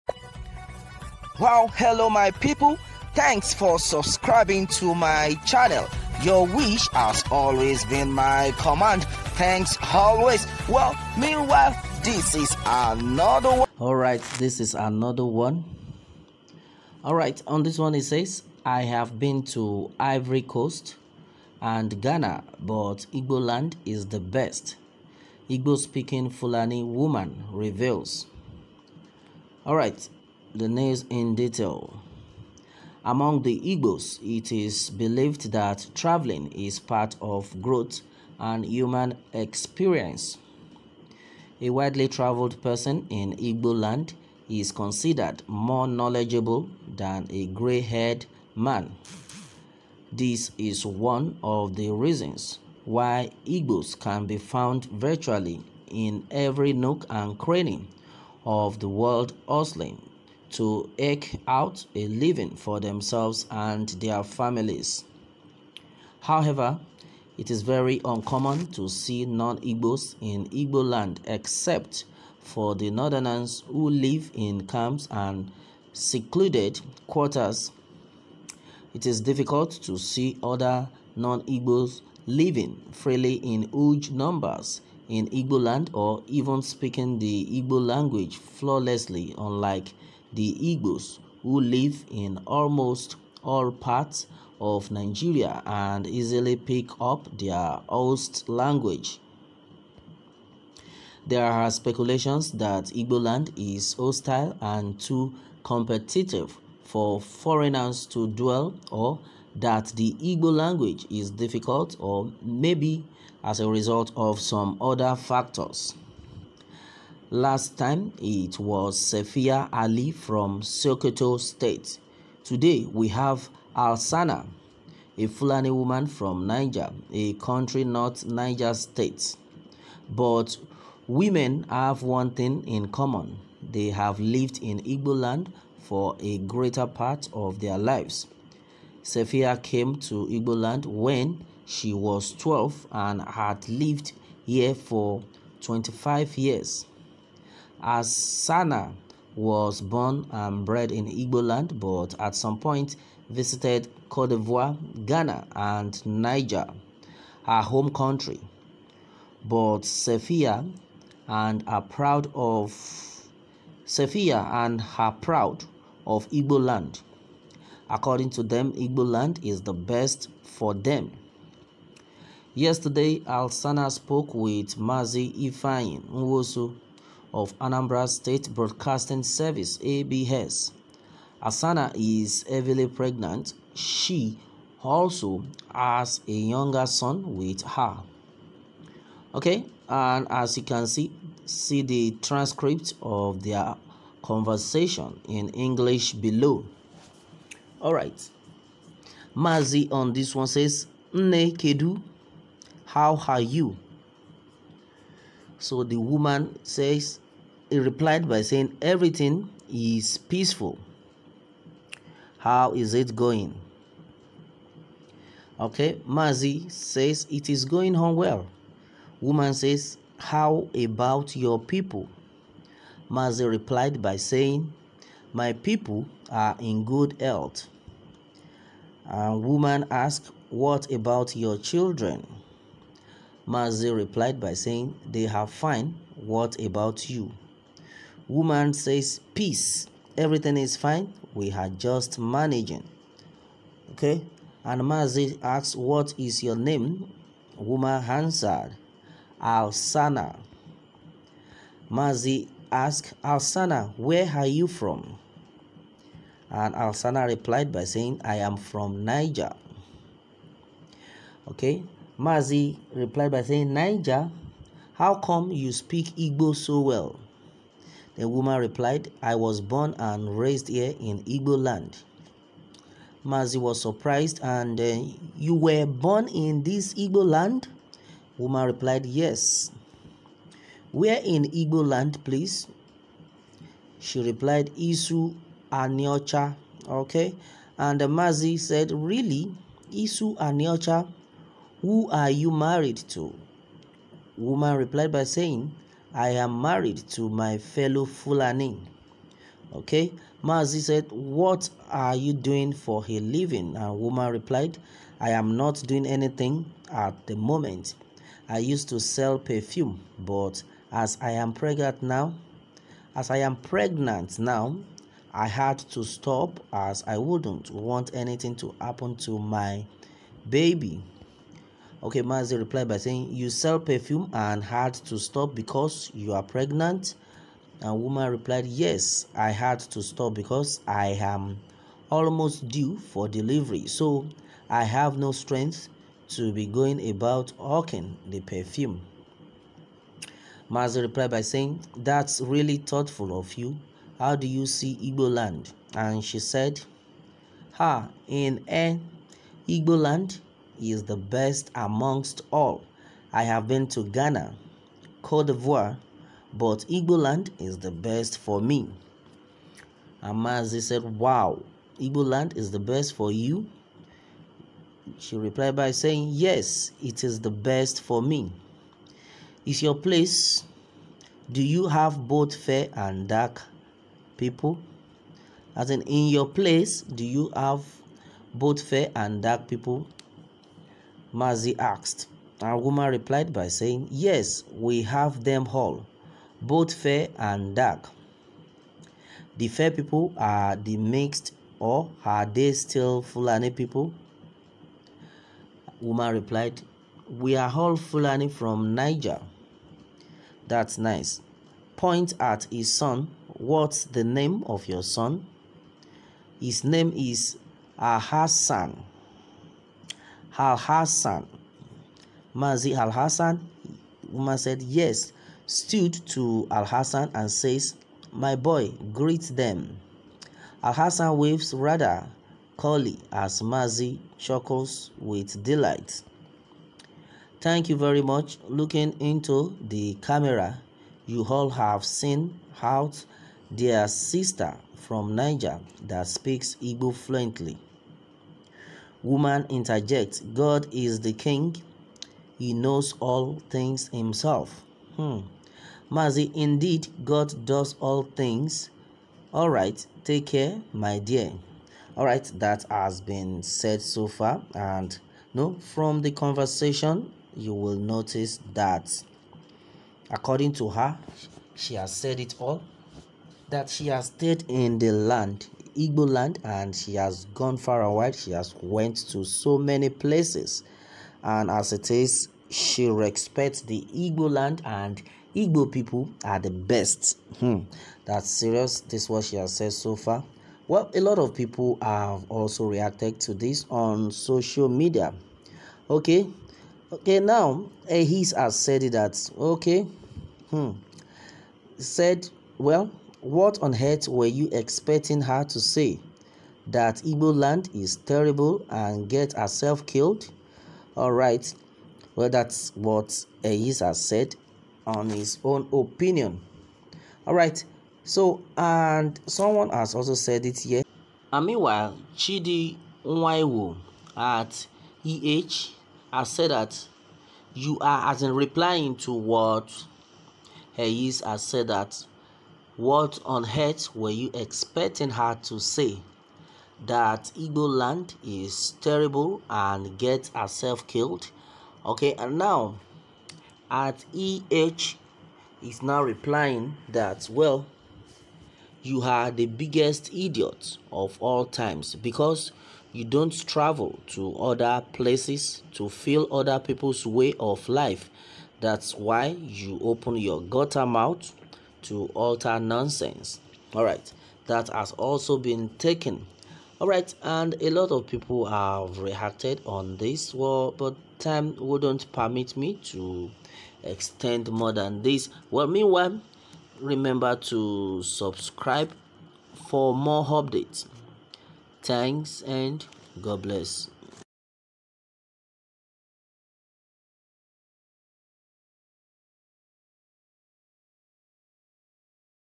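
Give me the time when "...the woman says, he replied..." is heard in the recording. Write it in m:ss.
3:25.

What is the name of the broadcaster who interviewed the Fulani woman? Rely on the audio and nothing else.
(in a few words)
Mazi Ifeanyi Nwosu.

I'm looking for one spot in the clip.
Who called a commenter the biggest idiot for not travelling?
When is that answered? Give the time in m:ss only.
8:32.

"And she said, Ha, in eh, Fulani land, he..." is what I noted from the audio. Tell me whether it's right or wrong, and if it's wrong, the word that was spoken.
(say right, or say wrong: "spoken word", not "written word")
wrong: "Igbo", not "Fulani".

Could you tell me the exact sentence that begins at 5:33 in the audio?
So I have no strength to be going about hawking the perfume.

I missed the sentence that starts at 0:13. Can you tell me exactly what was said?
All right, this is another one.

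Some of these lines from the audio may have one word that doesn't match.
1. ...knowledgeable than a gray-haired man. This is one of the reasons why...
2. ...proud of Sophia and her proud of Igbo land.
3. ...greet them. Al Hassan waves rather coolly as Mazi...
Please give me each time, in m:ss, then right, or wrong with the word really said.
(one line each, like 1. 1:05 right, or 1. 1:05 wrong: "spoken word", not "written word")
1. 0:45 right
2. 2:41 right
3. 6:59 right.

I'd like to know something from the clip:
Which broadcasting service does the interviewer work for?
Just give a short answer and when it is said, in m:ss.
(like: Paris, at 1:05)
Anambra State Broadcasting Service, at 2:57.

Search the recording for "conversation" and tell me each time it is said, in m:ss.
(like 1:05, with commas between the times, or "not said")
3:14, 7:36.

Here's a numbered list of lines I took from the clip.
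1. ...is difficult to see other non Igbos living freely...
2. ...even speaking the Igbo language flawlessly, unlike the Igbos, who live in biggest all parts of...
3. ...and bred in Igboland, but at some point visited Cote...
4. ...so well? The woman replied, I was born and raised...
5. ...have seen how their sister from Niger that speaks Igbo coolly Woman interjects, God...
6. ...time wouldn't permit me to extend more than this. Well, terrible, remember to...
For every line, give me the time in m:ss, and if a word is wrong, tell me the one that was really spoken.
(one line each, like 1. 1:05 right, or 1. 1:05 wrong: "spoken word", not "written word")
1. 1:19 right
2. 1:26 wrong: "almost", not "biggest"
3. 2:30 right
4. 4:26 right
5. 7:11 wrong: "fluently", not "coolly"
6. 9:21 wrong: "meanwhile", not "terrible".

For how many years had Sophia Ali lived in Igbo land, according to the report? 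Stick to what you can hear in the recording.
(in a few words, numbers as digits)
25.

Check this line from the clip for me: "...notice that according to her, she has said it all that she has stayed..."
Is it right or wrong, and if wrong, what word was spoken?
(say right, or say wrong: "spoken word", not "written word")
right.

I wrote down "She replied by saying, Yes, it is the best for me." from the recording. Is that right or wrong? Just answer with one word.
right.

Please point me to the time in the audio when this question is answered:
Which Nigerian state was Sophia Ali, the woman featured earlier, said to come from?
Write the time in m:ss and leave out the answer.
2:00.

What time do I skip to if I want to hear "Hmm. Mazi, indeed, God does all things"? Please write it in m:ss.
7:25.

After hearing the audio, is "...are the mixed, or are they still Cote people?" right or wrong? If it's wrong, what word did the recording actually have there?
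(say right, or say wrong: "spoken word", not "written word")
wrong: "Fulani", not "Cote".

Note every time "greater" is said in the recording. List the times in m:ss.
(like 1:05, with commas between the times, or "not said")
2:16.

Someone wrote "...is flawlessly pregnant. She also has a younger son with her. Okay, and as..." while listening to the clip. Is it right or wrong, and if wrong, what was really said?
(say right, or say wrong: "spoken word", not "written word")
wrong: "heavily", not "flawlessly".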